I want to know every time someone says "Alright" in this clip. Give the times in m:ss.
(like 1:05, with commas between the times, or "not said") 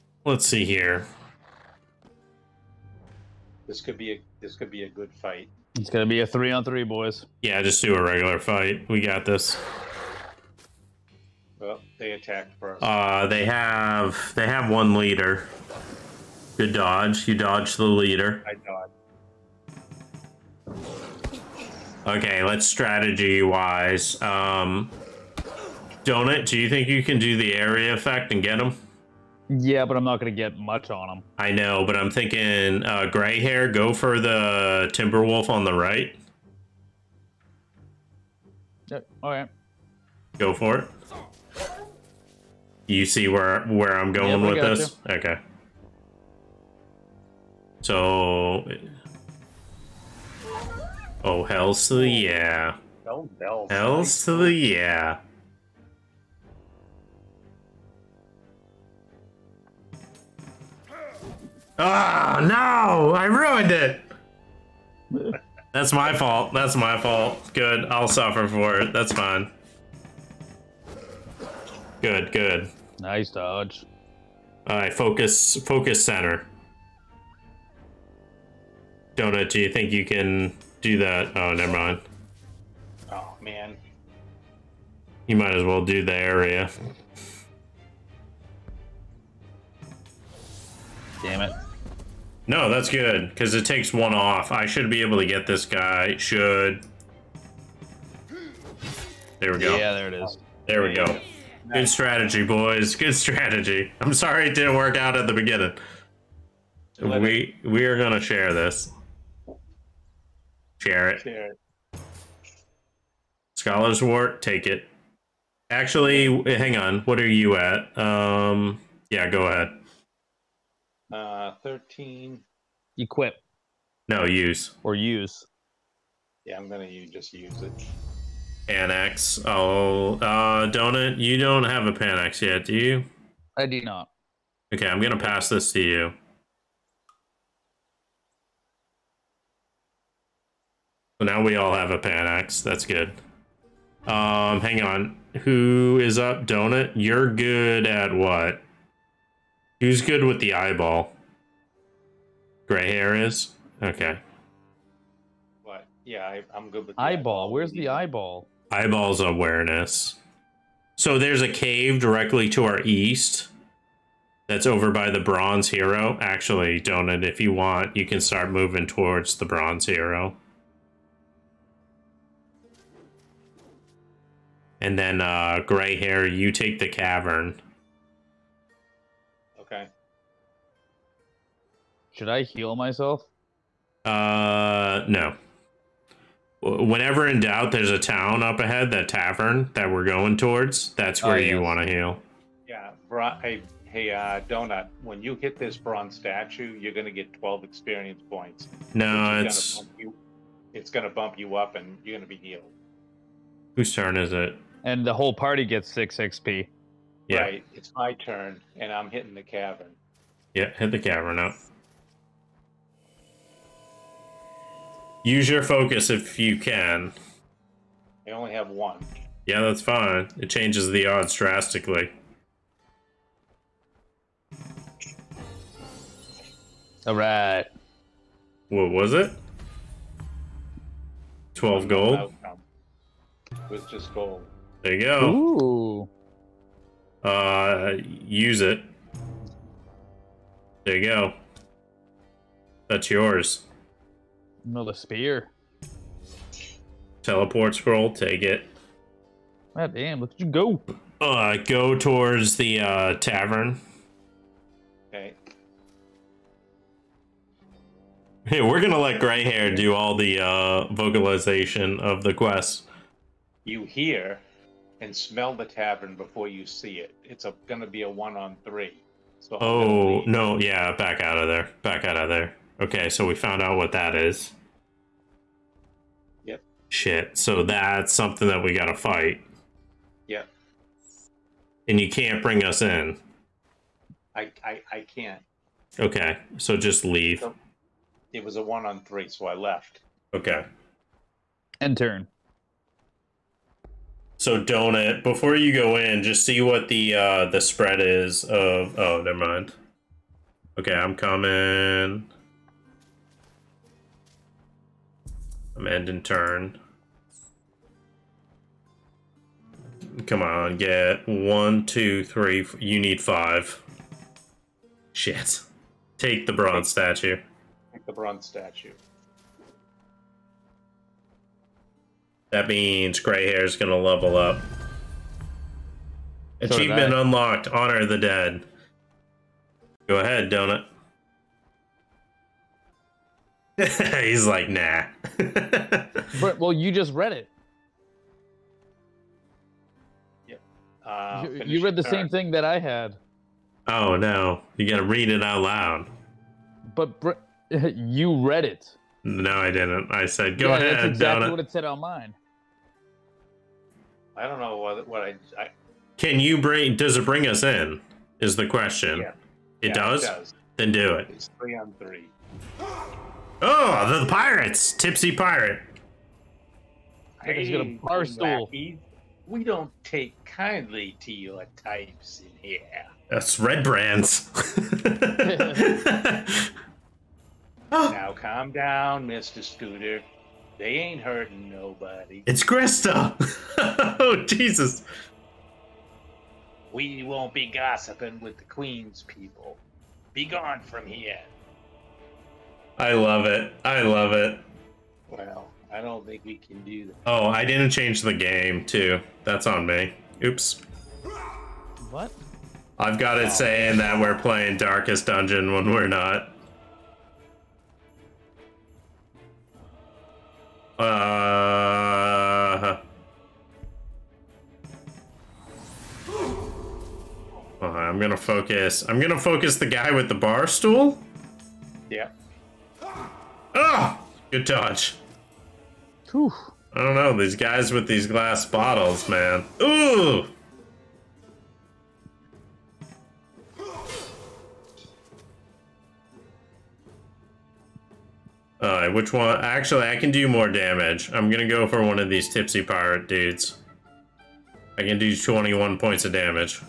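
1:14, 7:18.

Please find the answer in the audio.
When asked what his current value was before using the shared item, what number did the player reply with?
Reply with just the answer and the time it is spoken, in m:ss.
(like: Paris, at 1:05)
13, at 2:01.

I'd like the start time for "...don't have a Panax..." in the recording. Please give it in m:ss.
2:11.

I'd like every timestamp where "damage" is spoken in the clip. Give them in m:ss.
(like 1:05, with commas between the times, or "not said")
7:20, 7:26.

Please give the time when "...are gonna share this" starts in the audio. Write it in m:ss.
1:47.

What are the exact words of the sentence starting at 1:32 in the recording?
No, that's good, because it takes one off.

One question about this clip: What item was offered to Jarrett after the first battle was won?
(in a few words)
Scholar's Wort.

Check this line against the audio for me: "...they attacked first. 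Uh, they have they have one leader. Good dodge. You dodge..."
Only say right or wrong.
right.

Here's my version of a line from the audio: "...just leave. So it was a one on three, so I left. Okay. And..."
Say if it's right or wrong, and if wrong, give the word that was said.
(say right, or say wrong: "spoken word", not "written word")
right.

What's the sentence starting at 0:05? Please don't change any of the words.
It's gonna be a three on three, boys.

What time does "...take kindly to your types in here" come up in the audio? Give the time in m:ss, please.
6:10.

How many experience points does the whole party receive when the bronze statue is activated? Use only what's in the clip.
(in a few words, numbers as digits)
6.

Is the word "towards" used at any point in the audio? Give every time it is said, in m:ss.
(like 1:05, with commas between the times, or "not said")
2:48, 3:10, 4:11.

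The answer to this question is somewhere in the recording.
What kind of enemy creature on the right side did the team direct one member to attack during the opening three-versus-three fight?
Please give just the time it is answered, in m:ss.
0:34.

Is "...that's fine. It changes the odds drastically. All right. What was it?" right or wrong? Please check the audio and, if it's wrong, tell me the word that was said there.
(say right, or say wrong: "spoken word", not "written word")
right.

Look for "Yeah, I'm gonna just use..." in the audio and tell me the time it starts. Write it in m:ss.
2:06.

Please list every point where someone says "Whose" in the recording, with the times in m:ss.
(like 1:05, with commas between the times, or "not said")
3:23.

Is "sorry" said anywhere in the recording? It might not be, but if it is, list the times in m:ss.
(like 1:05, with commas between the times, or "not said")
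1:44.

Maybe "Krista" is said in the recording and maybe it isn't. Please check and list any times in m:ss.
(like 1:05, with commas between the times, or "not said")
6:22.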